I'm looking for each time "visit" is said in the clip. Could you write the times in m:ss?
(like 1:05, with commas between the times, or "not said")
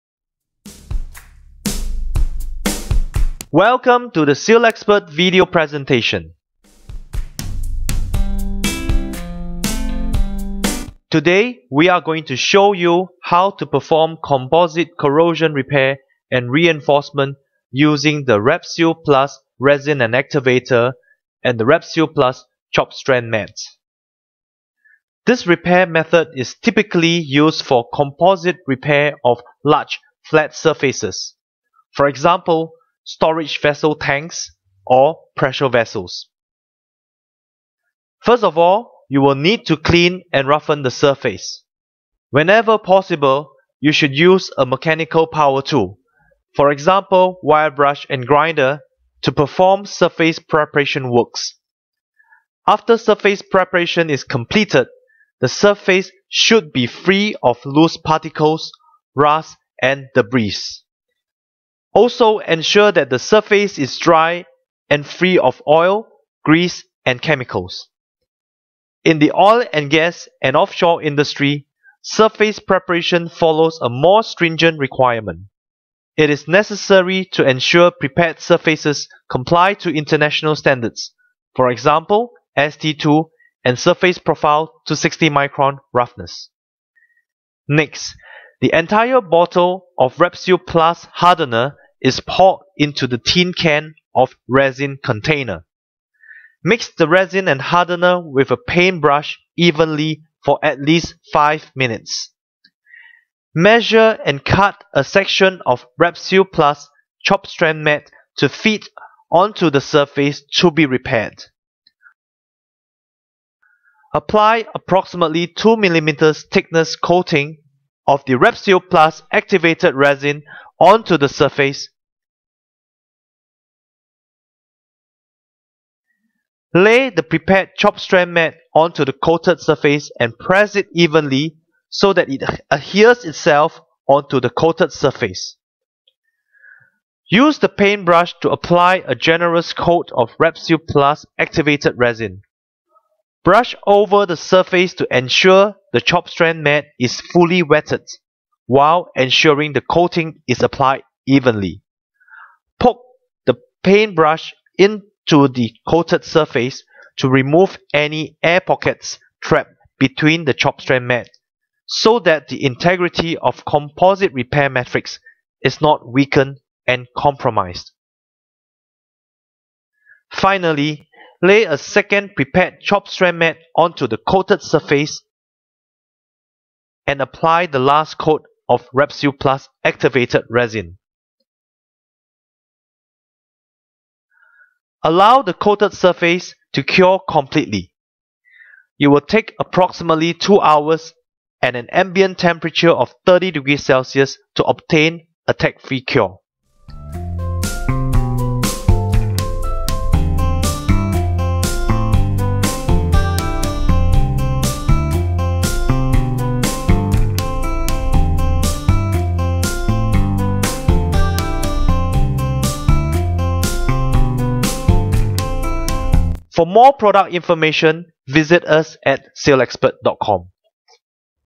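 3:38.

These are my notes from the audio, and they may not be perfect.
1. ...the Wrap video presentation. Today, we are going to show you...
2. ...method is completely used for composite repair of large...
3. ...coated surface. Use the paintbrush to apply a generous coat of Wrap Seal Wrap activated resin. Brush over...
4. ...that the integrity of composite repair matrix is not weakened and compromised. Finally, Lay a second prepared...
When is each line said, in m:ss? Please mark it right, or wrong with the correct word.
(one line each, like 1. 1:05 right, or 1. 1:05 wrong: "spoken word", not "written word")
1. 0:04 wrong: "SealXpert", not "Wrap"
2. 0:25 wrong: "typically", not "completely"
3. 2:14 wrong: "Plus", not "Wrap"
4. 2:42 right.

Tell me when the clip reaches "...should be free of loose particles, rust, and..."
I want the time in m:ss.
0:56.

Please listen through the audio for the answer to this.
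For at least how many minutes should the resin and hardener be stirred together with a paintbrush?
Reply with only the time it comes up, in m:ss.
1:41.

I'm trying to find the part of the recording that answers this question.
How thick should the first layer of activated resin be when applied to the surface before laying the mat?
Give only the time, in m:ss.
1:55.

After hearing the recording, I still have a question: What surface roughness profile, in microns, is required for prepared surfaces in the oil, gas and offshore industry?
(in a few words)
60 micron.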